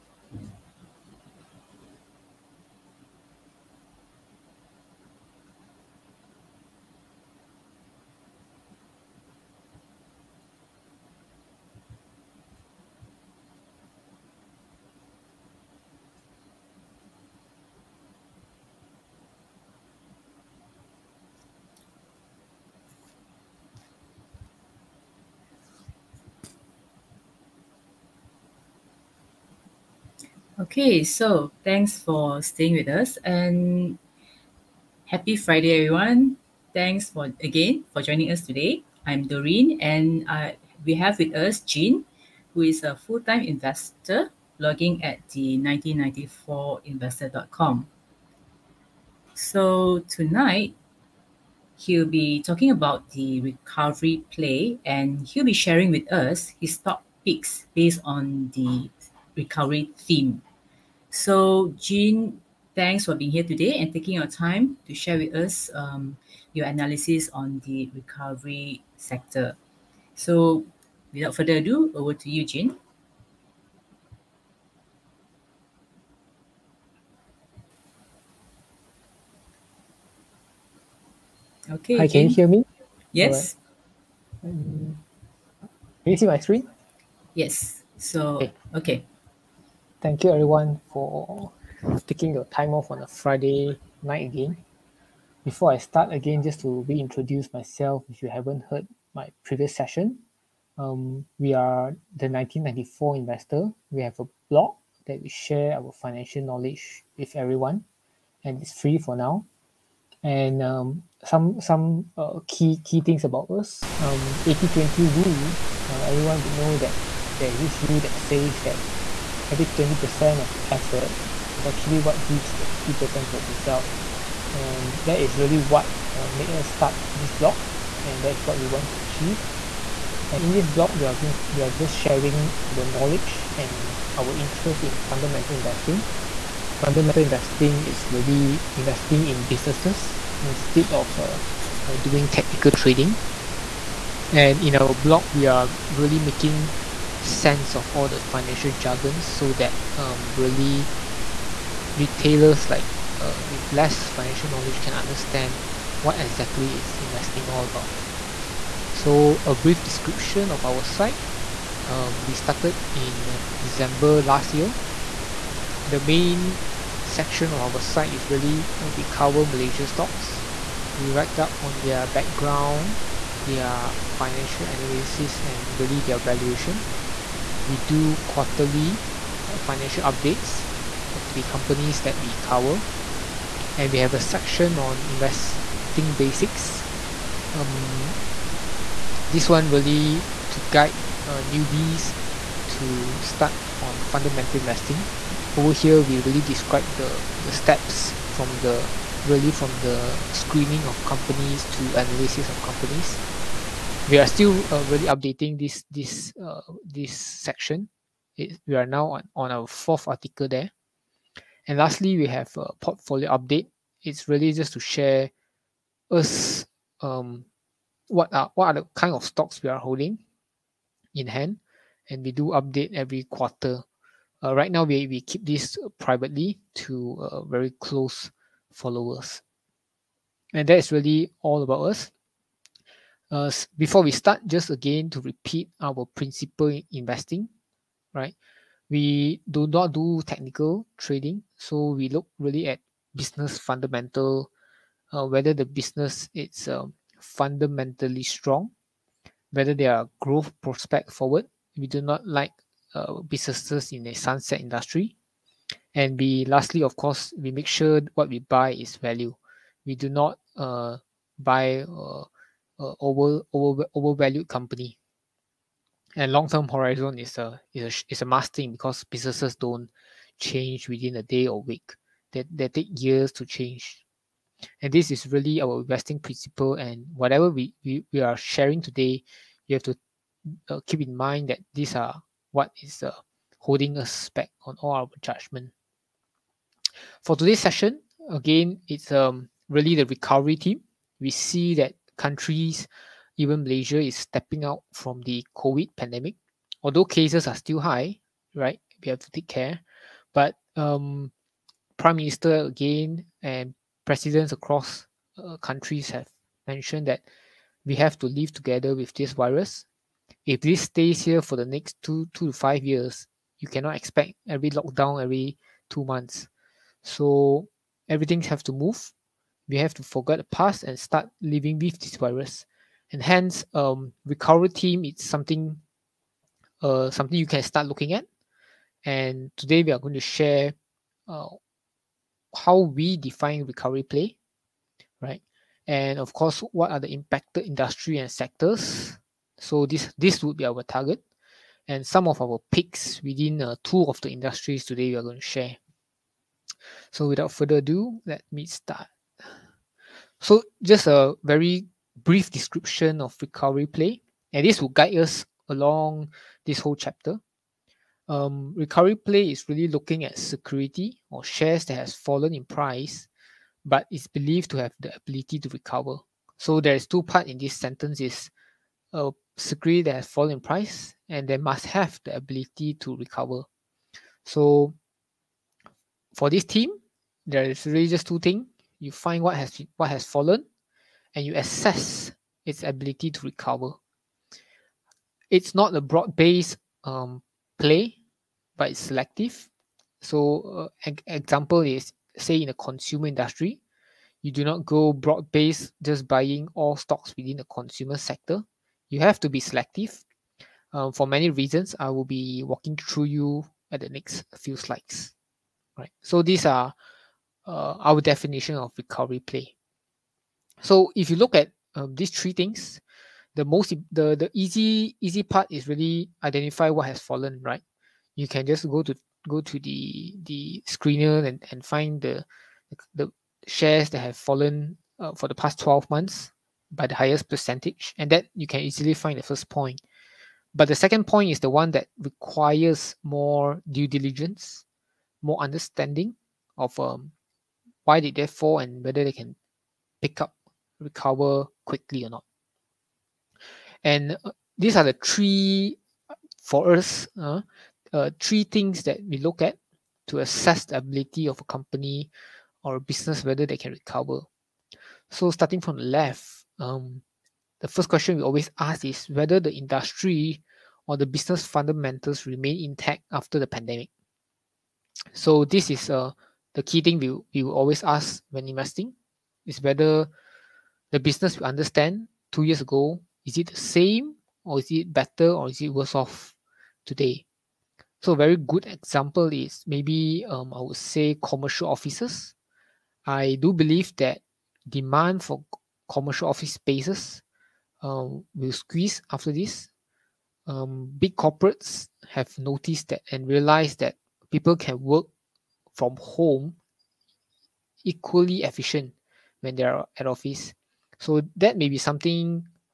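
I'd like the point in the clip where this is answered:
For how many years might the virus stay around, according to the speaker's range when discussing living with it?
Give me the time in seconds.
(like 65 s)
312 s.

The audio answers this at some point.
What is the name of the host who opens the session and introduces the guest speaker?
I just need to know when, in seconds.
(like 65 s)
39 s.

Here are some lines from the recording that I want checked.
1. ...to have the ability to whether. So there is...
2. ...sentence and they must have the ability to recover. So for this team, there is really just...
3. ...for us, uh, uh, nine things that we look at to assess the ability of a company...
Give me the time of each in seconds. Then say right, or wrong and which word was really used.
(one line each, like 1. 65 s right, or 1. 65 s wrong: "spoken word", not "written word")
1. 364 s wrong: "recover", not "whether"
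2. 370 s wrong: "price", not "sentence"
3. 446 s wrong: "three", not "nine".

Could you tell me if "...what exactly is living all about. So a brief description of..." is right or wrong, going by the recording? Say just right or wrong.
wrong.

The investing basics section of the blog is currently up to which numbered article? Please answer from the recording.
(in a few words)
fourth.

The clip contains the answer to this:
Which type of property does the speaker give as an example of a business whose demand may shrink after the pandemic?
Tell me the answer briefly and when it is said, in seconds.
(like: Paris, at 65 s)
commercial offices, at 481 s.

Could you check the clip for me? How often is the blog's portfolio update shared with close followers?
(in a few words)
every quarter.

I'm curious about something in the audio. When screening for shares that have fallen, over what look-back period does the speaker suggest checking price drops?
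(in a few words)
12 months.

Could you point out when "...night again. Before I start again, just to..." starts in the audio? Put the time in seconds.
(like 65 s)
94 s.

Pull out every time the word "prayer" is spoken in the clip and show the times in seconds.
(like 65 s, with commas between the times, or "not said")
not said.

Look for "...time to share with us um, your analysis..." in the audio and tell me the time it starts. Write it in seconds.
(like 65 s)
64 s.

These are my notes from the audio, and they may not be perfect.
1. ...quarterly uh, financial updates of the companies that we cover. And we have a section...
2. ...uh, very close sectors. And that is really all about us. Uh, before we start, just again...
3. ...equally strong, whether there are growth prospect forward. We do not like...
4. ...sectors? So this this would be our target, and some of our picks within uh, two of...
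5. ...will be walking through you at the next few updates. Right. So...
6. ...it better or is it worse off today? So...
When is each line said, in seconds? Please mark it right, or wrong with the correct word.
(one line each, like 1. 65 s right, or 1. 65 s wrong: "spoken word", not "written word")
1. 178 s right
2. 227 s wrong: "followers", not "sectors"
3. 247 s wrong: "fundamentally", not "equally"
4. 338 s right
5. 402 s wrong: "slides", not "updates"
6. 474 s right.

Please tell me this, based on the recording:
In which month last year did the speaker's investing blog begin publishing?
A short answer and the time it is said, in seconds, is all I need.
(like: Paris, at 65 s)
December, at 163 s.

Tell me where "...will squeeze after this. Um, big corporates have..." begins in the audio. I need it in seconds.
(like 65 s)
488 s.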